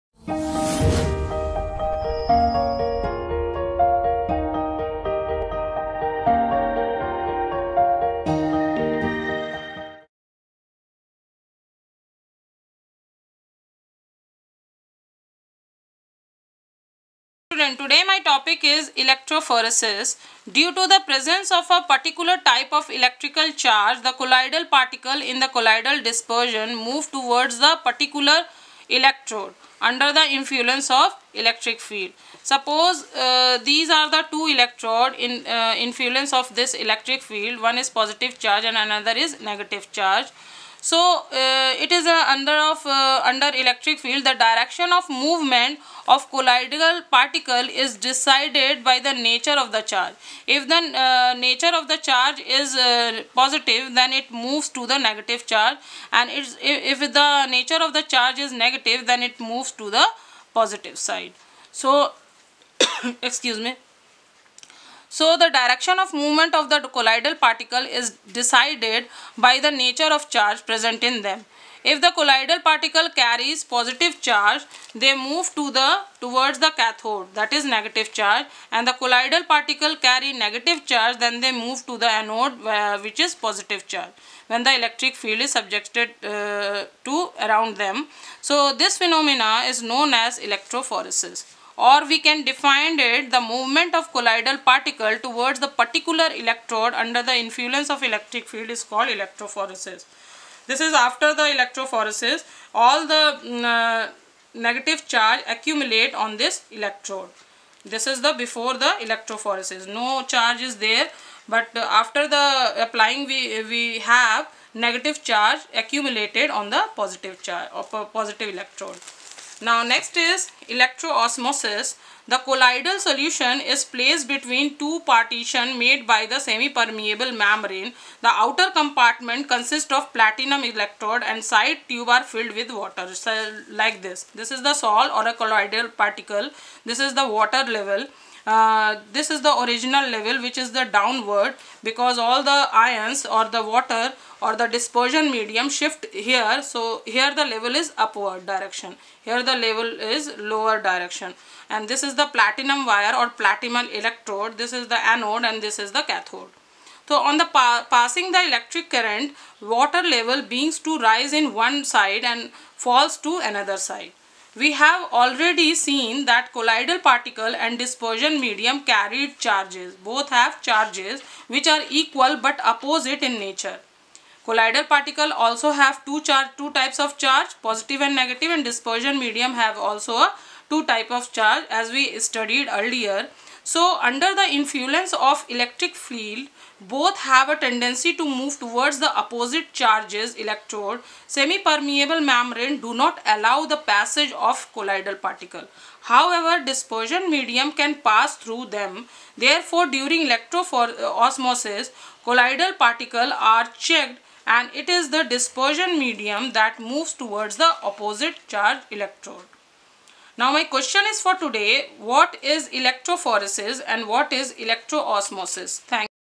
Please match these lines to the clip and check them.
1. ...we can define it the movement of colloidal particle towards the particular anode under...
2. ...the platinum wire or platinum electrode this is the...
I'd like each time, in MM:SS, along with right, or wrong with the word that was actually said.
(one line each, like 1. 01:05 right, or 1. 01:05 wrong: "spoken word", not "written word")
1. 01:32 wrong: "electrode", not "anode"
2. 02:32 right.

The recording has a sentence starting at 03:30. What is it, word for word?
Now my question is for today, what is electrophoresis and what is electroosmosis?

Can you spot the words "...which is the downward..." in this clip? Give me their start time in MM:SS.
02:20.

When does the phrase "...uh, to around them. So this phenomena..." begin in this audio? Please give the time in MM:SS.
01:26.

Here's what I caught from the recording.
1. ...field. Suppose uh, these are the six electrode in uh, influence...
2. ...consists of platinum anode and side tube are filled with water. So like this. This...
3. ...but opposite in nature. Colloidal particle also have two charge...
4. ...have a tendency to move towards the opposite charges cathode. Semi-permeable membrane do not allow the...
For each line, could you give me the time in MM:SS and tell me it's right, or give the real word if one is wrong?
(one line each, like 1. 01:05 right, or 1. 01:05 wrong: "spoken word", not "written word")
1. 00:31 wrong: "two", not "six"
2. 02:09 wrong: "electrode", not "anode"
3. 02:52 right
4. 03:07 wrong: "electrode", not "cathode".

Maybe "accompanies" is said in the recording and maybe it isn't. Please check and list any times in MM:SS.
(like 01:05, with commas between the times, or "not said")
not said.